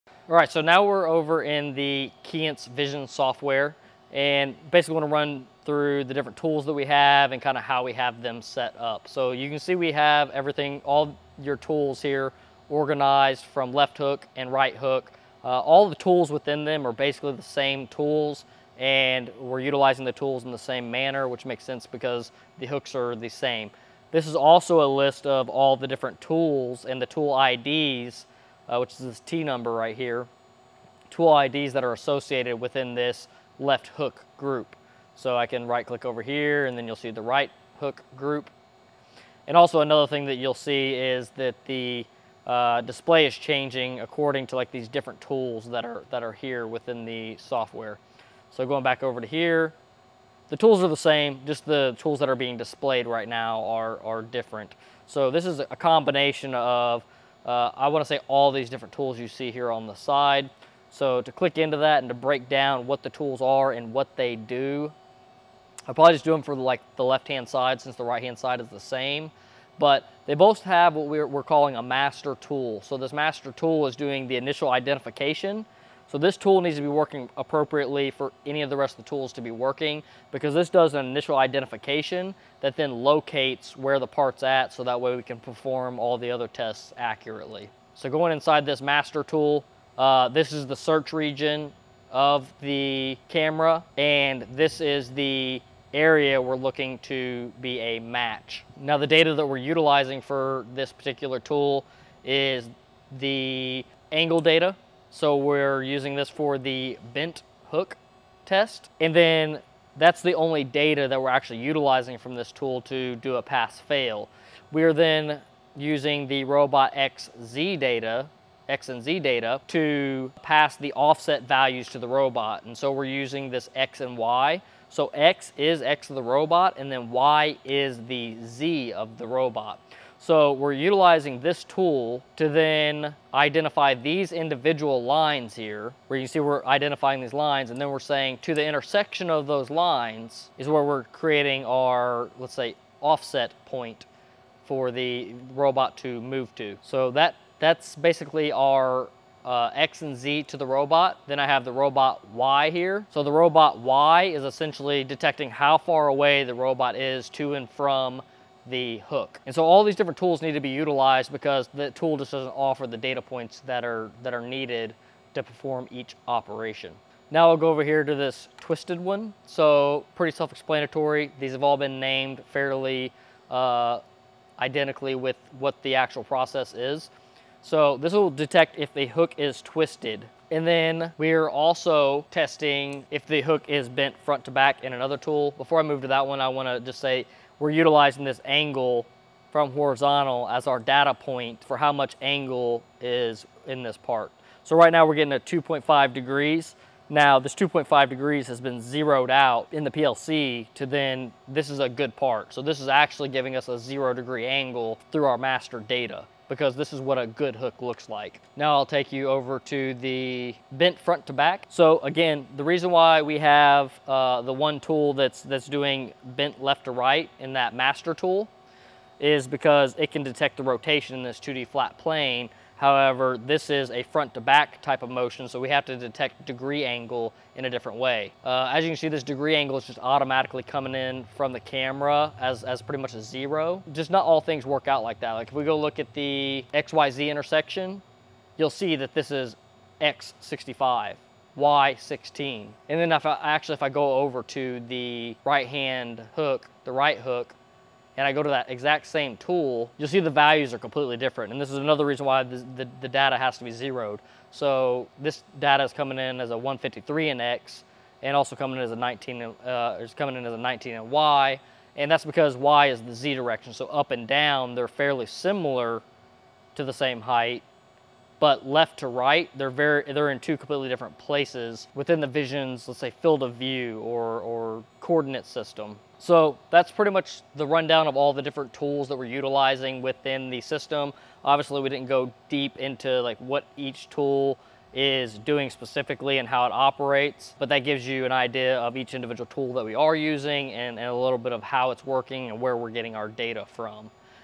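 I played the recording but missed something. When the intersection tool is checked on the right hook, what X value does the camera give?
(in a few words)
153.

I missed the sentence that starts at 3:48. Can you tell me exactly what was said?
Uh, as you can see, this degree angle is just automatically coming in from the camera as, as pretty much a zero.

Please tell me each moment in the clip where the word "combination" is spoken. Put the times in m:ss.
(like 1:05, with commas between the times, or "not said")
0:55.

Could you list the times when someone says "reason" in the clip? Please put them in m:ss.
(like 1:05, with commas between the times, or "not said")
3:32, 4:12.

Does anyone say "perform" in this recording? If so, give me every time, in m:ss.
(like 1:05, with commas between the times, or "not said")
1:25, 2:45.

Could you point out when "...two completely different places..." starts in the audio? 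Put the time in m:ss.
4:30.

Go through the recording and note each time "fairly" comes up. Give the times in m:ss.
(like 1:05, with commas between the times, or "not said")
2:52, 4:24.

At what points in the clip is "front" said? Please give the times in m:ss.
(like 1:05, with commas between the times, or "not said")
3:04, 3:30, 3:44.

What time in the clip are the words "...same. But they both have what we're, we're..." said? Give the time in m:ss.
1:08.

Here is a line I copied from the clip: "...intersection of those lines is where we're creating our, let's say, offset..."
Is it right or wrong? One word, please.
right.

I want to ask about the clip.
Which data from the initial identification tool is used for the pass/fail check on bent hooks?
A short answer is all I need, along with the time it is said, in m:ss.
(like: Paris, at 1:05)
angle data, at 1:44.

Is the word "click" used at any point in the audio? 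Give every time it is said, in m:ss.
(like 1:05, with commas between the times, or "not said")
0:35, 1:01.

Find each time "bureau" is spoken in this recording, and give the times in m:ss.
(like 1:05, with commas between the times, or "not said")
not said.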